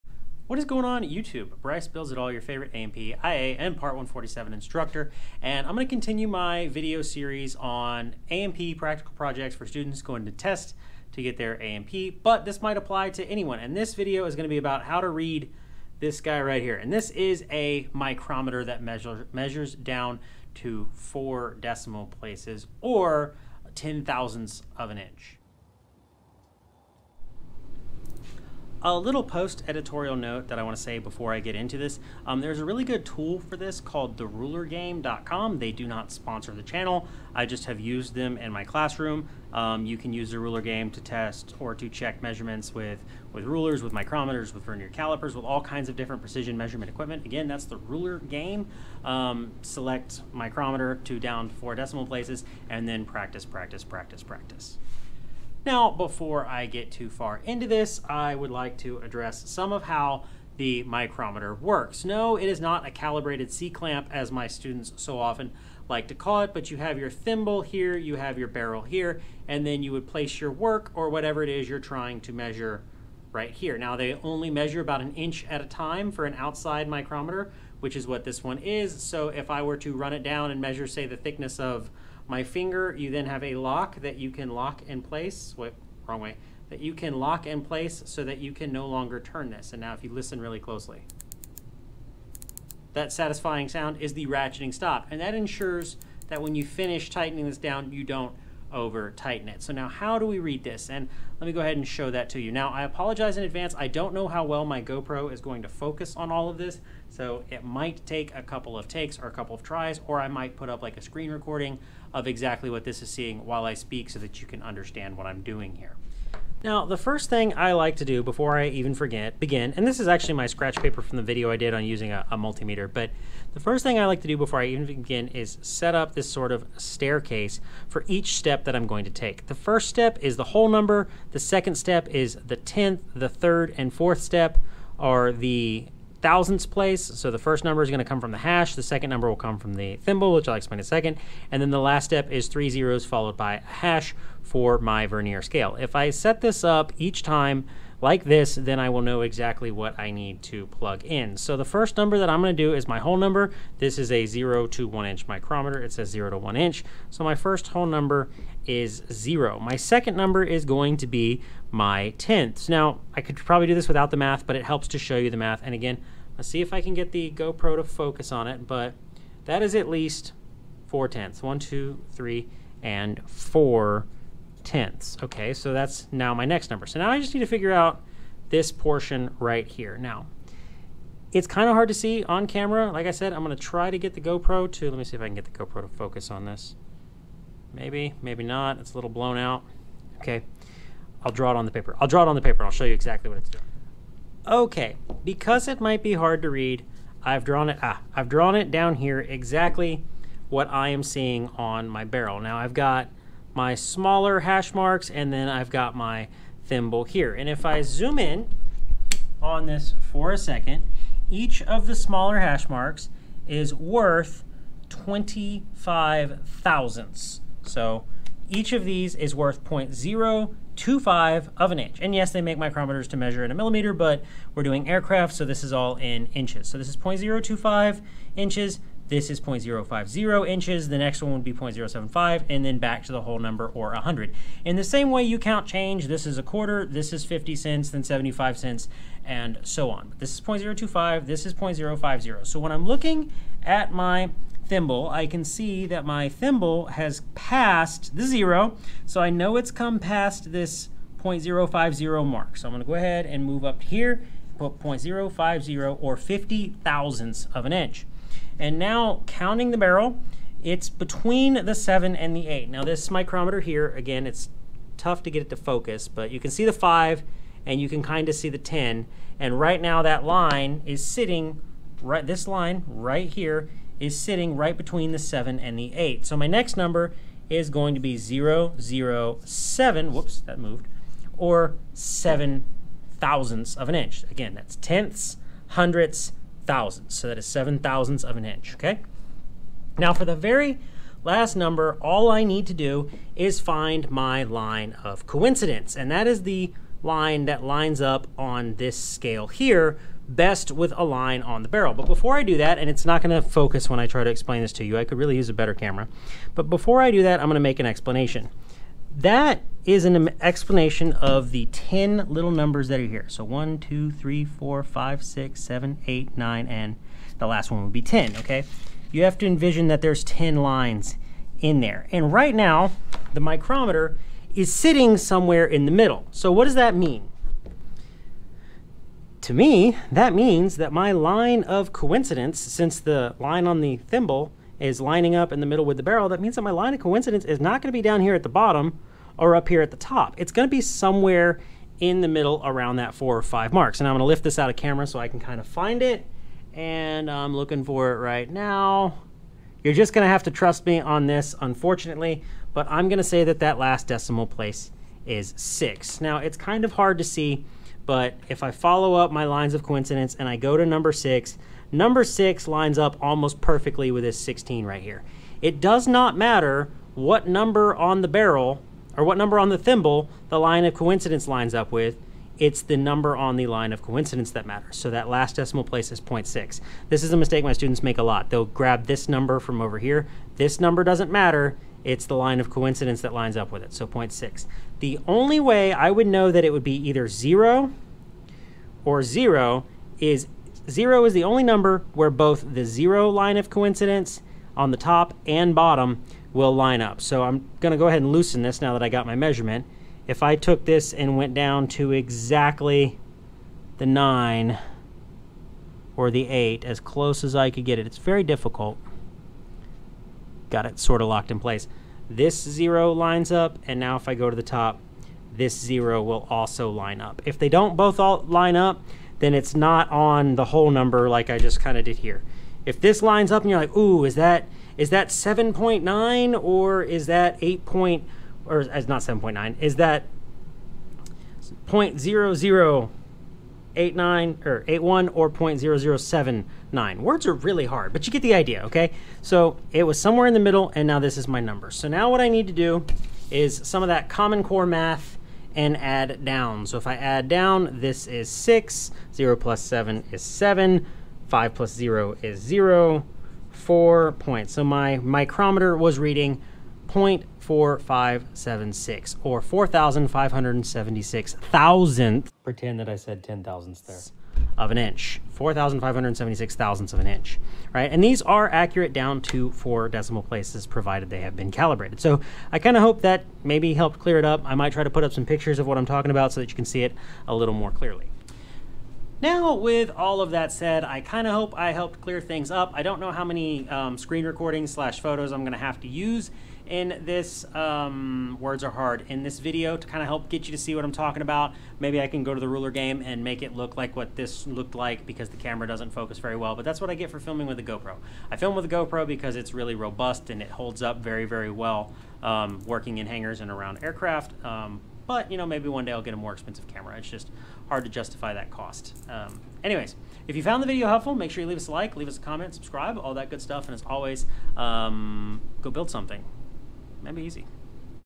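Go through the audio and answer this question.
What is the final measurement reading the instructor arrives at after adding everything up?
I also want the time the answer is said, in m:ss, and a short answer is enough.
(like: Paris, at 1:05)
0.4576, at 7:37.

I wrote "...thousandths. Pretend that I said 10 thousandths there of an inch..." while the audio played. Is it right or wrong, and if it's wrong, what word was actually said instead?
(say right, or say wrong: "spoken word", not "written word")
right.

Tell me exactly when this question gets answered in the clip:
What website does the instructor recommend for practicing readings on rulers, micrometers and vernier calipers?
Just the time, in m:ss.
0:34.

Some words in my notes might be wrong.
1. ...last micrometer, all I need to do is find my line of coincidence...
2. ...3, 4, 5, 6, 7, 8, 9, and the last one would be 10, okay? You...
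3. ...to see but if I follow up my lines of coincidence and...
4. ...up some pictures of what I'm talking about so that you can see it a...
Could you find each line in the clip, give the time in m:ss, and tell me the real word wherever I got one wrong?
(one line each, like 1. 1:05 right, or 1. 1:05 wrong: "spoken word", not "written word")
1. 4:51 wrong: "number", not "micrometer"
2. 5:14 right
3. 5:57 right
4. 7:55 right.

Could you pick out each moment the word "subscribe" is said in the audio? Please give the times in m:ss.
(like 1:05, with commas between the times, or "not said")
8:32.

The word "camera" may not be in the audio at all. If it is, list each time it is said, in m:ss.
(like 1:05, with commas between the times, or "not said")
3:02, 5:05, 5:44, 8:15, 8:26.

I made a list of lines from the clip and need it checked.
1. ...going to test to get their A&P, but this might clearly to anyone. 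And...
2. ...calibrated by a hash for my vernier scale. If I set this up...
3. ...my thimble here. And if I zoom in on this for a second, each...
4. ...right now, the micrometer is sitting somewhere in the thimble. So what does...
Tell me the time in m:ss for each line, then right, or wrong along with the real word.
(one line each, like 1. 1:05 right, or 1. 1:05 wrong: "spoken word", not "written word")
1. 0:10 wrong: "apply", not "clearly"
2. 2:23 wrong: "followed", not "calibrated"
3. 3:25 right
4. 5:22 wrong: "middle", not "thimble".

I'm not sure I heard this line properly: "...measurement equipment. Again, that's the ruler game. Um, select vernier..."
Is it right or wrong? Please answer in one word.
wrong.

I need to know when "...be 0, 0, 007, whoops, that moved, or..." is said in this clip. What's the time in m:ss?
4:37.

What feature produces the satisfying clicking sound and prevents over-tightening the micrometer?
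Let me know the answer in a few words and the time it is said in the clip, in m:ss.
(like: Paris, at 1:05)
ratcheting stop, at 1:34.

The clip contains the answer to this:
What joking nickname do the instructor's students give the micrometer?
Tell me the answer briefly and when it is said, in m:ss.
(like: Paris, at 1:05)
calibrated C-clamp, at 1:02.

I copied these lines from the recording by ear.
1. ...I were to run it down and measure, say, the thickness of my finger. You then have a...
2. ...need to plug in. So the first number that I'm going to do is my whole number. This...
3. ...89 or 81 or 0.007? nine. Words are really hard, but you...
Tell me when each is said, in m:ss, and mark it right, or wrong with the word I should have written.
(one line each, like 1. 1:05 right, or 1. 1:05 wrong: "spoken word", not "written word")
1. 1:19 right
2. 2:30 right
3. 7:13 right.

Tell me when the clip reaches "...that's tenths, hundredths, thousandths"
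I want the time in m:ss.
4:44.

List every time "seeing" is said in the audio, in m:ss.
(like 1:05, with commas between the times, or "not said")
1:53, 3:21.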